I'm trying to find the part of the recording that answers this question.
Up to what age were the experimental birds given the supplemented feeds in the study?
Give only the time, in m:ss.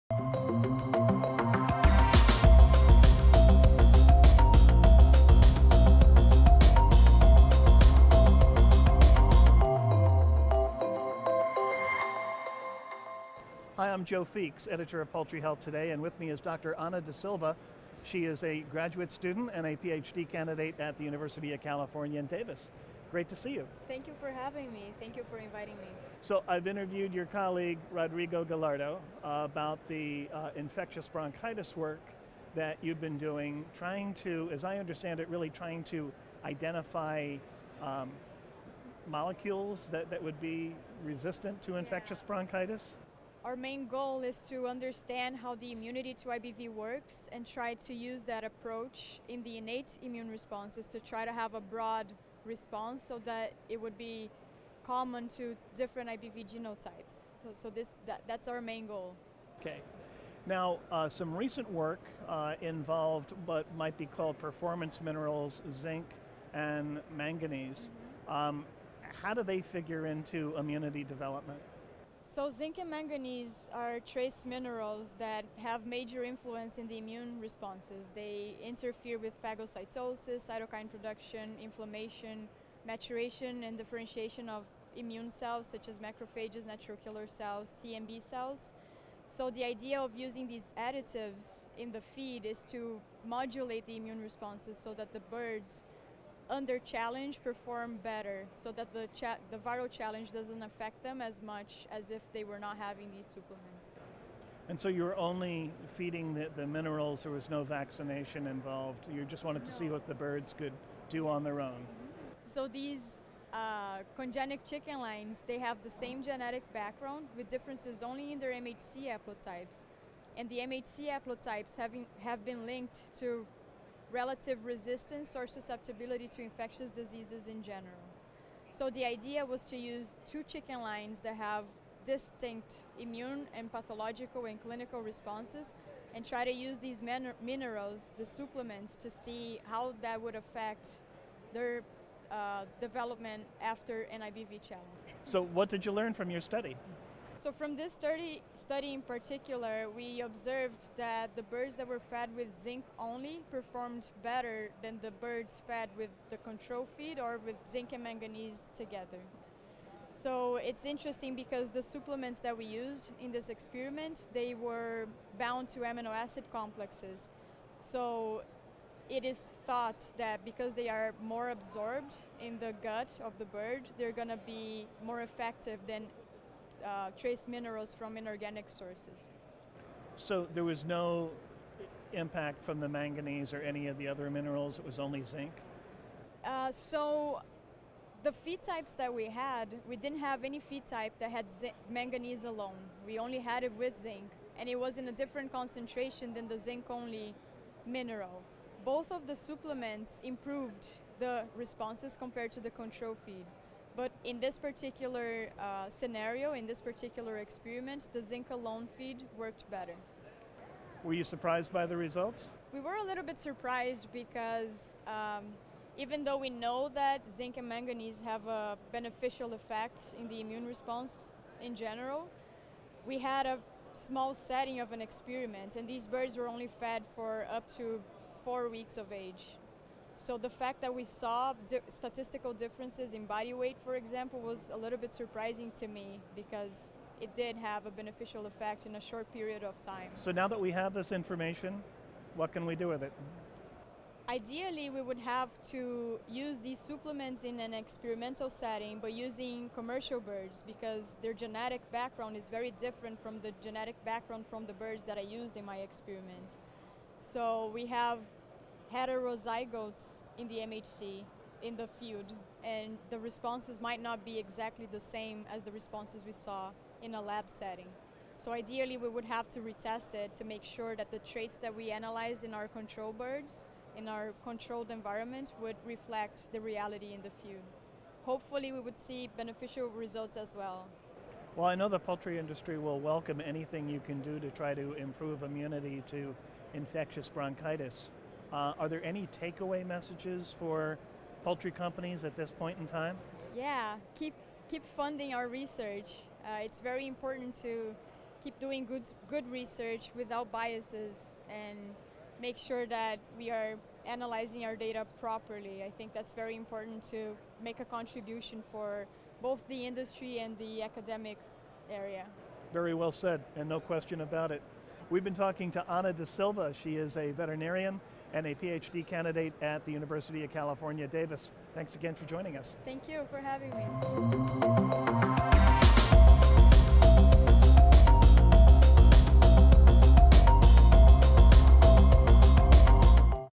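3:48.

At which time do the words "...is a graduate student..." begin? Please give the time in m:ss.
0:18.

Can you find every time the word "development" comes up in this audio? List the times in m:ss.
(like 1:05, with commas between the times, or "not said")
1:11, 2:22.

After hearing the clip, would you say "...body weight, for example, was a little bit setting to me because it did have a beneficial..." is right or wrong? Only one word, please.
wrong.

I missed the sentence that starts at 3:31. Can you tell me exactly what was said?
Were you surprised by the results?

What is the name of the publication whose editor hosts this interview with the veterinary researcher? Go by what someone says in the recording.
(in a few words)
Poultry Health Today.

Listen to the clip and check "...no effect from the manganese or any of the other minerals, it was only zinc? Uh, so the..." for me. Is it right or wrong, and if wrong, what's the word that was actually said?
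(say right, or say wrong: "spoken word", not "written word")
wrong: "impact", not "effect".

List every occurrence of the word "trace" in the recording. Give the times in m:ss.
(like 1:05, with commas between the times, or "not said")
1:13, 2:57.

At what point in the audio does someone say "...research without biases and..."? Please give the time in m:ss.
4:59.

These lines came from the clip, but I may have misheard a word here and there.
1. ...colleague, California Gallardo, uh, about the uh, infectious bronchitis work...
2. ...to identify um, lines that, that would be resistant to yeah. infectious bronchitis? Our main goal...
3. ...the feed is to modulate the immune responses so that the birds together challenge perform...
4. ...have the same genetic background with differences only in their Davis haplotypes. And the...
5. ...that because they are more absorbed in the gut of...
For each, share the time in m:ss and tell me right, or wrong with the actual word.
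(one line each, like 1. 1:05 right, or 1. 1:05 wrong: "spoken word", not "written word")
1. 0:27 wrong: "Rodrigo", not "California"
2. 0:35 wrong: "molecules", not "lines"
3. 1:31 wrong: "under", not "together"
4. 1:55 wrong: "MHC", not "Davis"
5. 2:50 right.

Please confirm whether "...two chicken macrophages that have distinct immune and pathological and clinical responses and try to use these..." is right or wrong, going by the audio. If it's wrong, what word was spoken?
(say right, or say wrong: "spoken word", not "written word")
wrong: "lines", not "macrophages".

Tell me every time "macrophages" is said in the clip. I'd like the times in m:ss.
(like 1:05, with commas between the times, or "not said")
1:25.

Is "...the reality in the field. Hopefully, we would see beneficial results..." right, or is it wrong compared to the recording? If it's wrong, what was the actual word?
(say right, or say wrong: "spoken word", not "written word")
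right.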